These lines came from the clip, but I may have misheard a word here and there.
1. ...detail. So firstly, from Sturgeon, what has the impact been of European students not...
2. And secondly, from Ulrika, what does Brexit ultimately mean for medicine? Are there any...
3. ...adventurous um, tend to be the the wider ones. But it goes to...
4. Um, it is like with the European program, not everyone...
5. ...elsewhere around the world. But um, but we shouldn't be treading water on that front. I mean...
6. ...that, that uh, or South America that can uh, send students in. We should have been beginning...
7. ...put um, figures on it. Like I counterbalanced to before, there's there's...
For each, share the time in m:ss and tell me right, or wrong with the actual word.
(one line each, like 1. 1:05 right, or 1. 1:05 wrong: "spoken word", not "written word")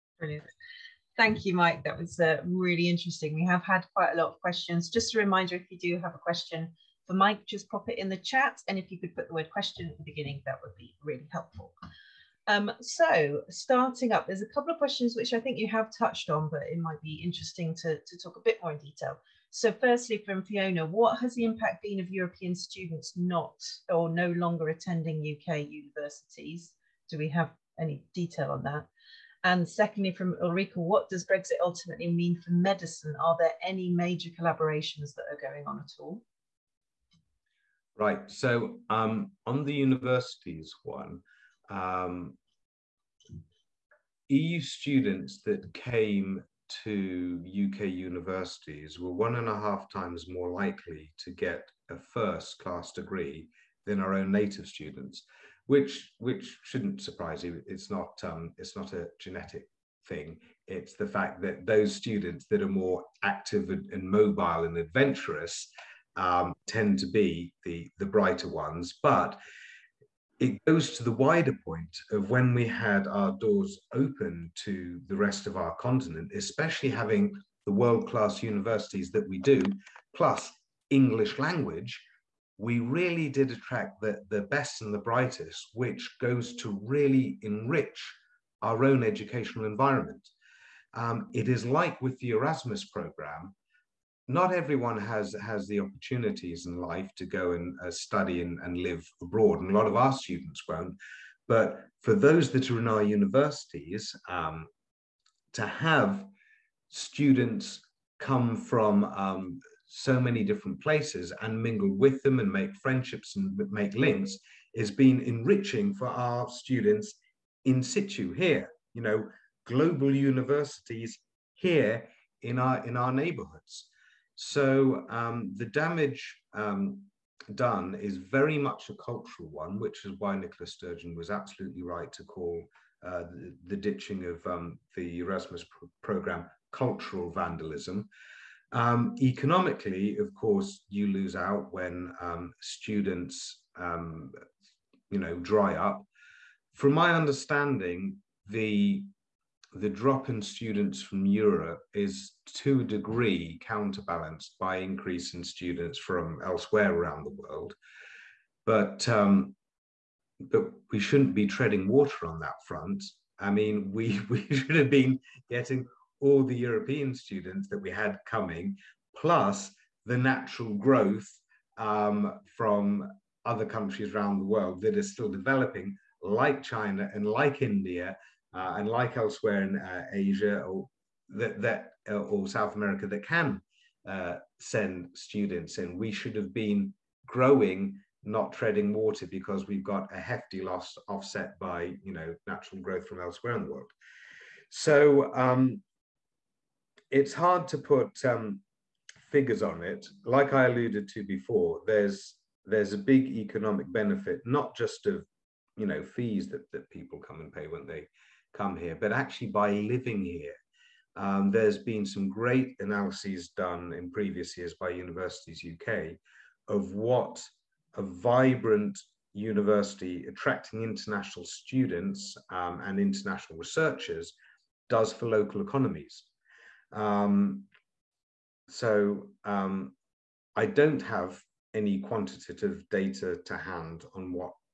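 1. 0:18 wrong: "Fiona", not "Sturgeon"
2. 0:29 right
3. 1:04 wrong: "brighter", not "wider"
4. 1:30 wrong: "Erasmus", not "European"
5. 2:36 right
6. 3:01 wrong: "growing", not "beginning"
7. 3:17 wrong: "alluded", not "counterbalanced".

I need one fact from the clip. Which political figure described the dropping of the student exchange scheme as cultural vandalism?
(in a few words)
Nicola Sturgeon.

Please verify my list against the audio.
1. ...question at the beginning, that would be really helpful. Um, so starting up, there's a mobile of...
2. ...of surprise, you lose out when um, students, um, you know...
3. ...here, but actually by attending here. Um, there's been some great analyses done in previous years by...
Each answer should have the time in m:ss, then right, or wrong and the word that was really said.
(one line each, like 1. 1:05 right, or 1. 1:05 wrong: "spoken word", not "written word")
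1. 0:09 wrong: "couple", not "mobile"
2. 2:20 wrong: "course", not "surprise"
3. 3:28 wrong: "living", not "attending".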